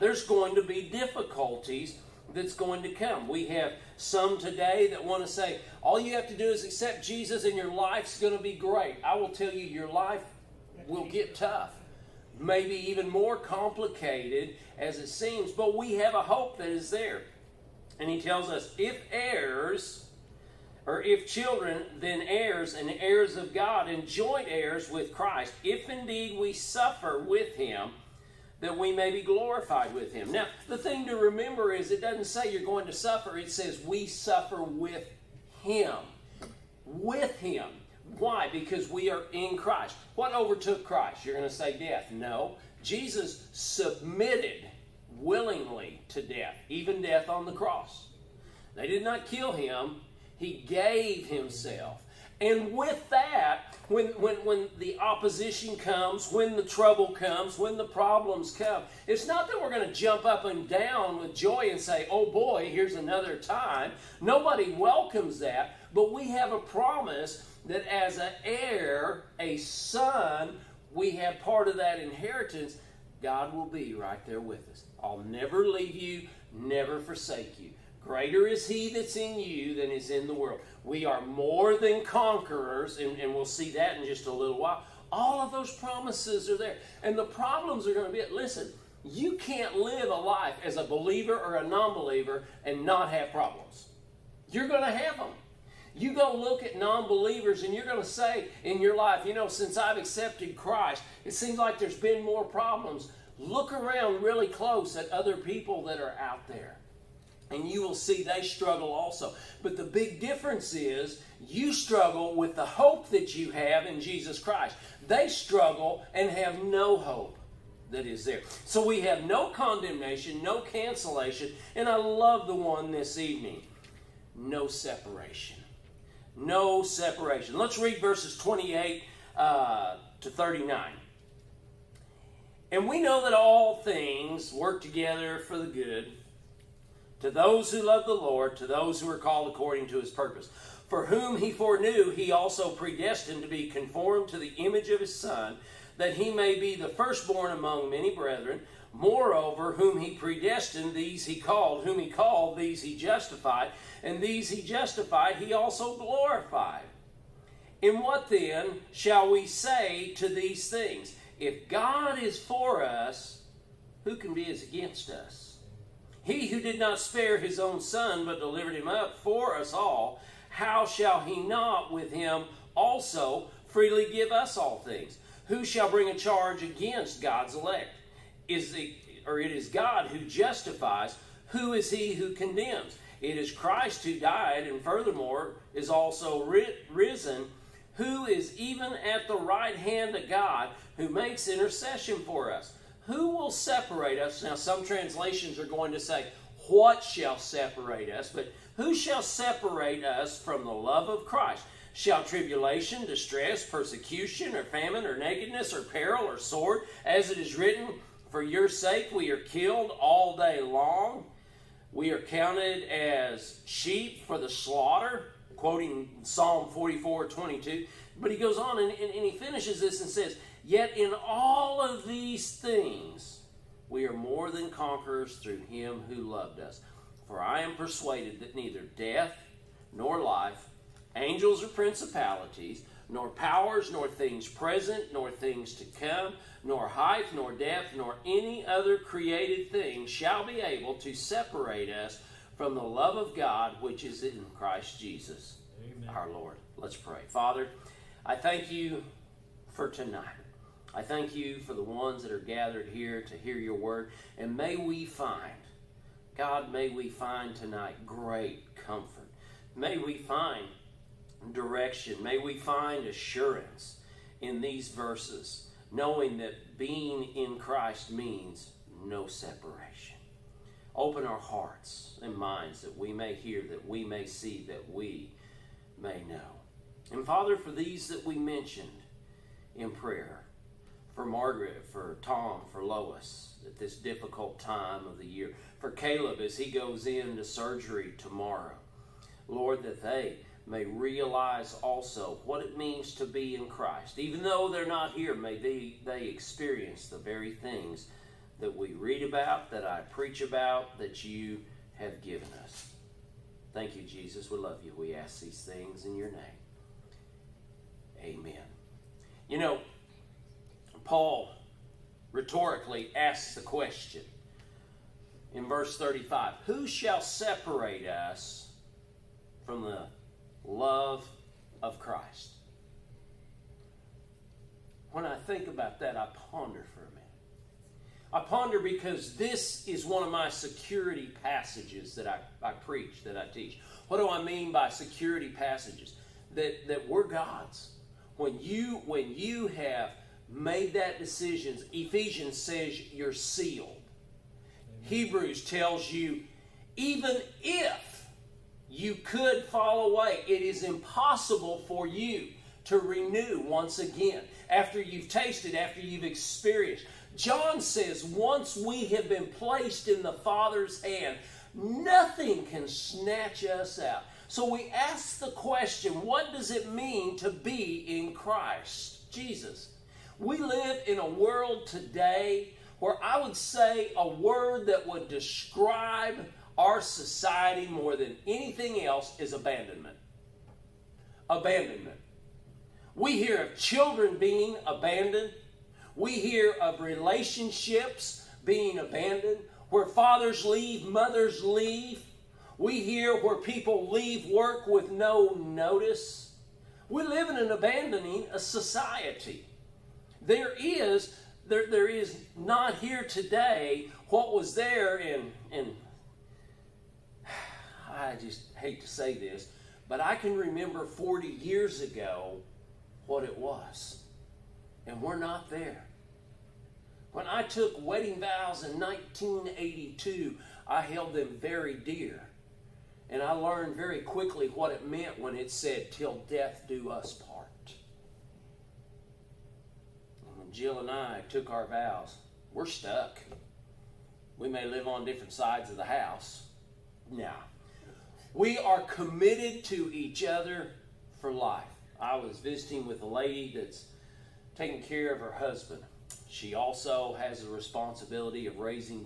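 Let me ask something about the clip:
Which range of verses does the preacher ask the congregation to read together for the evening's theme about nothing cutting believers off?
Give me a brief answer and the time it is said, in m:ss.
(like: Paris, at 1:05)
28 to 39, at 2:08.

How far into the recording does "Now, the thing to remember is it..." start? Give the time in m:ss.
0:30.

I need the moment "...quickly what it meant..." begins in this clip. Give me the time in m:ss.
7:04.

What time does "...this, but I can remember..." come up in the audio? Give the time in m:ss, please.
6:49.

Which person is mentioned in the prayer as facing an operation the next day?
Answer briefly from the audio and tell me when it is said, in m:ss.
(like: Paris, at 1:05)
Caleb, at 4:45.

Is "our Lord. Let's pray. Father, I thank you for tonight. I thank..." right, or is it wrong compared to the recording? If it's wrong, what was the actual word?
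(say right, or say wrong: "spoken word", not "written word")
right.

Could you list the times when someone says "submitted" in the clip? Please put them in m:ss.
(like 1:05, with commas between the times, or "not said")
0:43.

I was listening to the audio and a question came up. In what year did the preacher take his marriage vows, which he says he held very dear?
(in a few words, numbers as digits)
1982.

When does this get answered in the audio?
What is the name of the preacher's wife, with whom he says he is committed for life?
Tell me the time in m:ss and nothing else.
7:10.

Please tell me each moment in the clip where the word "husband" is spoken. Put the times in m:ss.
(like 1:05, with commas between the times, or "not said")
7:25.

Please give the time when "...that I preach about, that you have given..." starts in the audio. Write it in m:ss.
4:59.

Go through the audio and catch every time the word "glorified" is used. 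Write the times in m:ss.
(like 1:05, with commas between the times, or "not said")
0:29, 2:35.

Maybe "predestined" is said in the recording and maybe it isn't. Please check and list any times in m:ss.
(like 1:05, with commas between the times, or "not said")
2:22, 2:30.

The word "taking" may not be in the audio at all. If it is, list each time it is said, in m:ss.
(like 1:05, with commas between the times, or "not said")
7:24.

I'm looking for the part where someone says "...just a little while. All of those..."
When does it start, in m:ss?
1:24.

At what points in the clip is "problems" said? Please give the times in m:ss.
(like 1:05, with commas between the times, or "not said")
0:57, 1:27, 1:33, 1:42.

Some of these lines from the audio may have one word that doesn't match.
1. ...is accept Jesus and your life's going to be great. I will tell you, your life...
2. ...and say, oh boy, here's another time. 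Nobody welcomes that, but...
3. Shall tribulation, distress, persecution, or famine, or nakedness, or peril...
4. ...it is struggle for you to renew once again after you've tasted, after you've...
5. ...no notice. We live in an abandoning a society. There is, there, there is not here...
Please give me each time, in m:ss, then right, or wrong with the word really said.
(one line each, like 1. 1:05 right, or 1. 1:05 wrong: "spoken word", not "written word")
1. 0:06 right
2. 1:01 right
3. 3:21 right
4. 5:50 wrong: "impossible", not "struggle"
5. 6:35 right.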